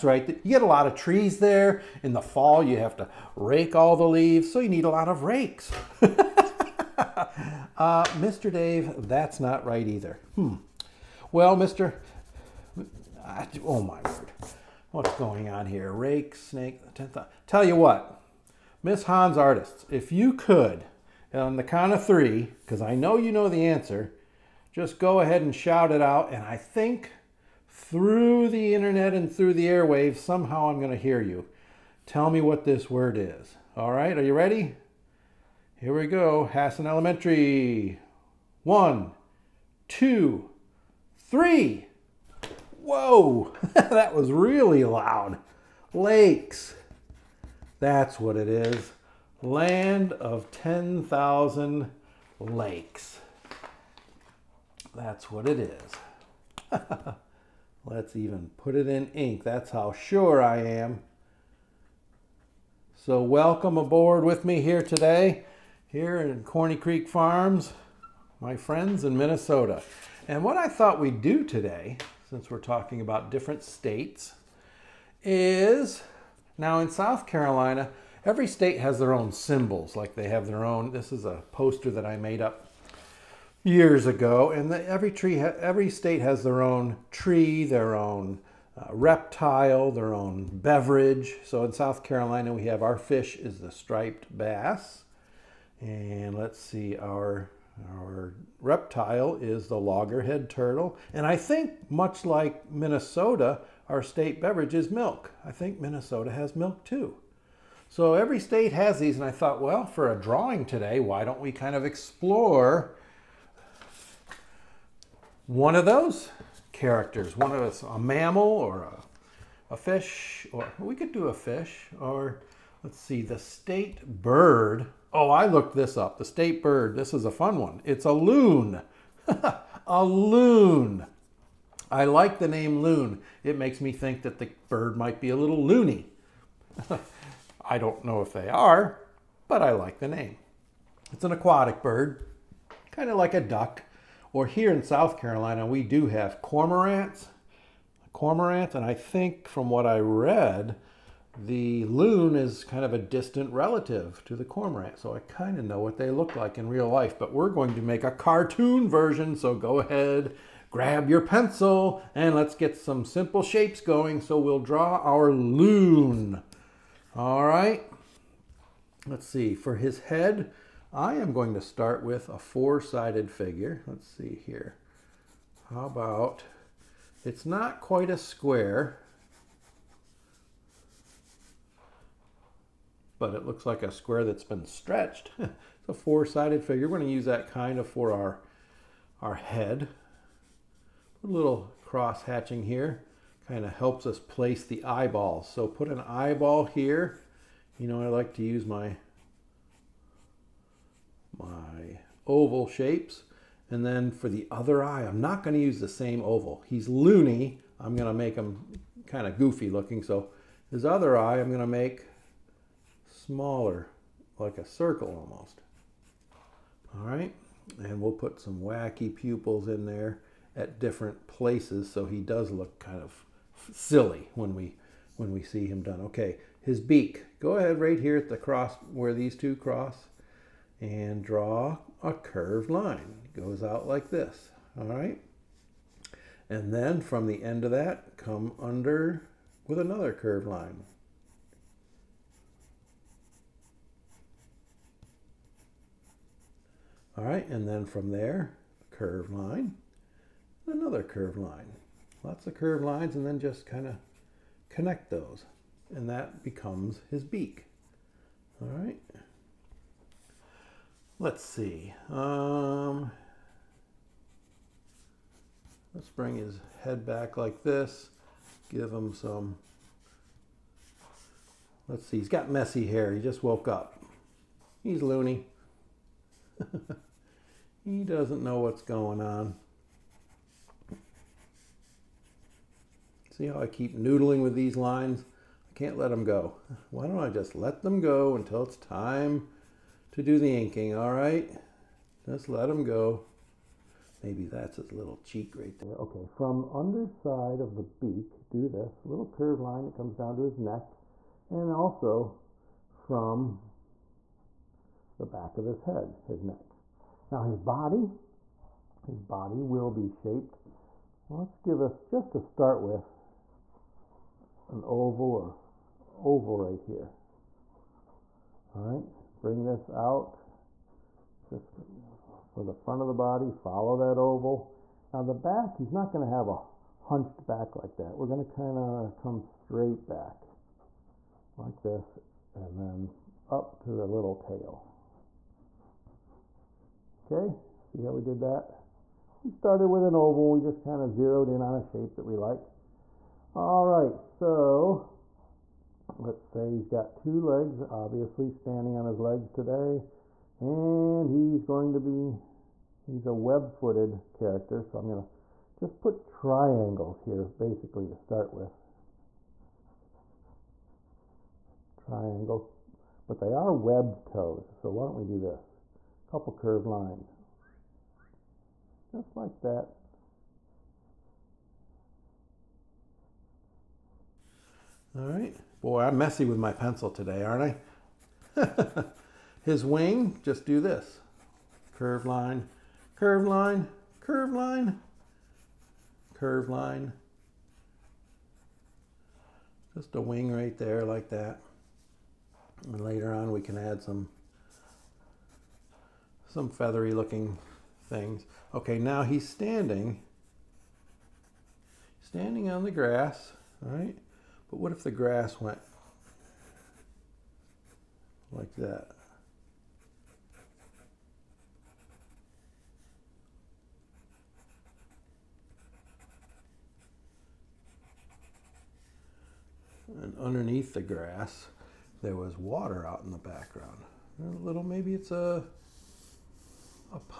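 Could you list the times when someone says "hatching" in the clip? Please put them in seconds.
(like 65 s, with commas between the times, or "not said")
192 s.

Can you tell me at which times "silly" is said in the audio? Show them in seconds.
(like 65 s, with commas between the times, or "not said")
223 s.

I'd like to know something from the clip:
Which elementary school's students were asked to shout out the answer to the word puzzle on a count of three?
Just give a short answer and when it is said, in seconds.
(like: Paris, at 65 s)
Hassan Elementary, at 36 s.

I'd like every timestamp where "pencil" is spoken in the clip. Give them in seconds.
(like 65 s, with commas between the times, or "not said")
161 s, 376 s.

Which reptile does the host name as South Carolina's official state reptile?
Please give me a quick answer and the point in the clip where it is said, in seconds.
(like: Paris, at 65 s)
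Loggerhead turtle, at 99 s.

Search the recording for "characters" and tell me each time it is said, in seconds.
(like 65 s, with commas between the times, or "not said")
116 s, 354 s.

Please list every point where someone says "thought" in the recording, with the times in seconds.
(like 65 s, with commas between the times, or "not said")
70 s, 109 s.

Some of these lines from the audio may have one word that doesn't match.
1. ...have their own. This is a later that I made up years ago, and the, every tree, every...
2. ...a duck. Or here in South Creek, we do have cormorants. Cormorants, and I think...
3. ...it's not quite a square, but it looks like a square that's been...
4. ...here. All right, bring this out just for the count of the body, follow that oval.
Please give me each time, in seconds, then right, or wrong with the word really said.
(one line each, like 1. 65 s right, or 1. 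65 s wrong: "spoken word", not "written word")
1. 80 s wrong: "poster", not "later"
2. 143 s wrong: "Carolina", not "Creek"
3. 177 s right
4. 316 s wrong: "front", not "count".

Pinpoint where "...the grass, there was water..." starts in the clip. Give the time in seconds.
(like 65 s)
420 s.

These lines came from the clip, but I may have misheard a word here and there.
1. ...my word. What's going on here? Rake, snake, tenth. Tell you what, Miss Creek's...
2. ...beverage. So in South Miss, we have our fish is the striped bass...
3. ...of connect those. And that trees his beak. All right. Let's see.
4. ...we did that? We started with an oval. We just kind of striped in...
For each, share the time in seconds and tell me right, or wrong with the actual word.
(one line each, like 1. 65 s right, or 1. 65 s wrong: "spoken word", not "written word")
1. 13 s wrong: "Hahn", not "Creek"
2. 90 s wrong: "Carolina", not "Miss"
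3. 253 s wrong: "becomes", not "trees"
4. 338 s wrong: "zeroed", not "striped".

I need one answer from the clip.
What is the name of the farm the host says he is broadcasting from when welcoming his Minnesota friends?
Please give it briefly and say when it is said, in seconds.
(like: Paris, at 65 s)
Corny Creek Farms, at 66 s.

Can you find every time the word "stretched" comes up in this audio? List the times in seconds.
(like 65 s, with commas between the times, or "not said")
184 s.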